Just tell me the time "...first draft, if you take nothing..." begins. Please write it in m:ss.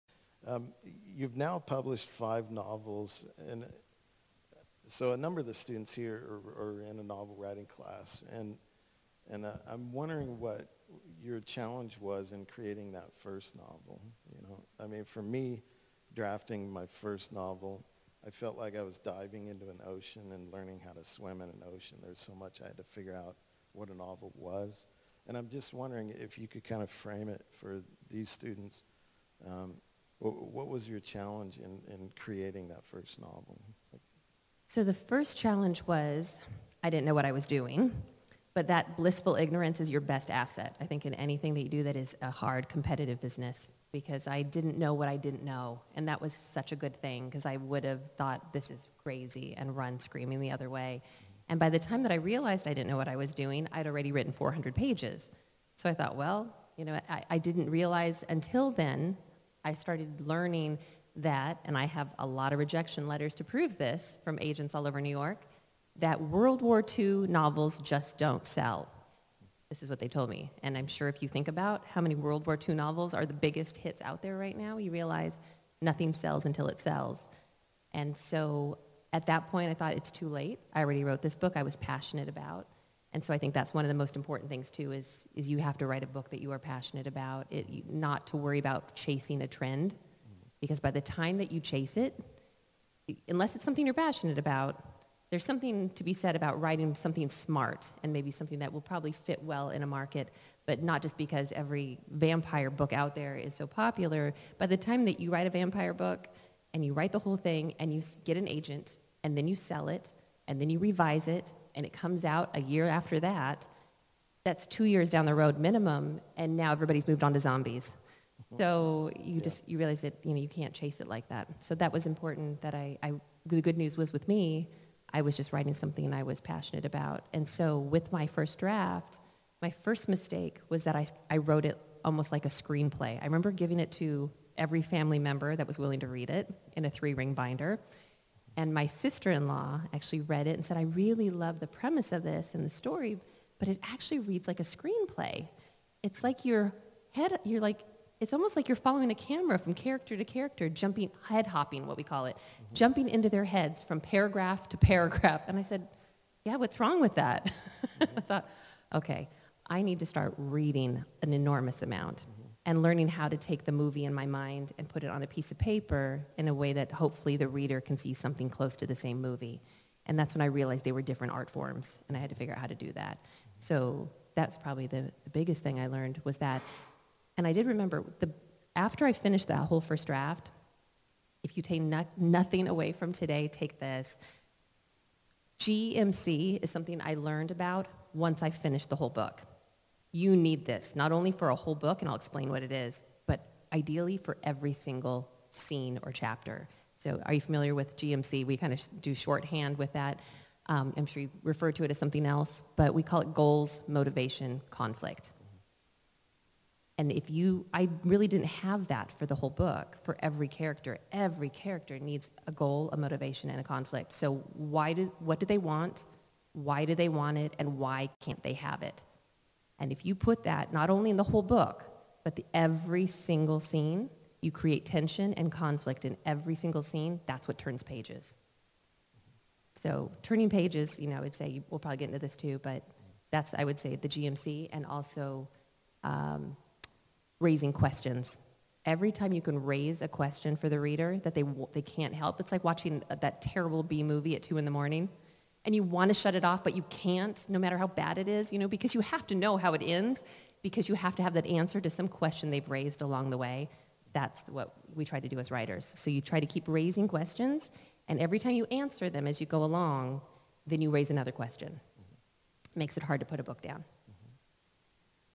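2:59.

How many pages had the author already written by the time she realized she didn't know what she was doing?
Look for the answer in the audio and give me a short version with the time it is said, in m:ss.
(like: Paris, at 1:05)
400, at 0:54.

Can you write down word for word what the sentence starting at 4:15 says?
So you try to keep raising questions, and every time you answer them as you go along, then you raise another question.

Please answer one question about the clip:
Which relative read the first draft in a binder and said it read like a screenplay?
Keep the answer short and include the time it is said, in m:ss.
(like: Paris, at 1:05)
sister-in-law, at 2:18.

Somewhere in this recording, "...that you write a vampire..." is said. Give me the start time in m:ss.
1:45.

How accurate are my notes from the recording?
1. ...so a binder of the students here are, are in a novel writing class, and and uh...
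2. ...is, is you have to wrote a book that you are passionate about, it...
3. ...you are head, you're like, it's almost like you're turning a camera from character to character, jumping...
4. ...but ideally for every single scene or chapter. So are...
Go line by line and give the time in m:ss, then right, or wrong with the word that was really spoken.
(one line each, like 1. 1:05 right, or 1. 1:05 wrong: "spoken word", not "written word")
1. 0:04 wrong: "number", not "binder"
2. 1:24 wrong: "write", not "wrote"
3. 2:26 wrong: "following", not "turning"
4. 3:13 right.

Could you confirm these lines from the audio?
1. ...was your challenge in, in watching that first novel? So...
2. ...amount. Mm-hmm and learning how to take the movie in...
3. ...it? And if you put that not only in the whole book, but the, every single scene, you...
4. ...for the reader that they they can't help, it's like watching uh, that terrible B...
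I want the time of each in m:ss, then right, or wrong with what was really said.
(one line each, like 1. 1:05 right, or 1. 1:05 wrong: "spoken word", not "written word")
1. 0:30 wrong: "creating", not "watching"
2. 2:41 right
3. 3:38 right
4. 4:00 right.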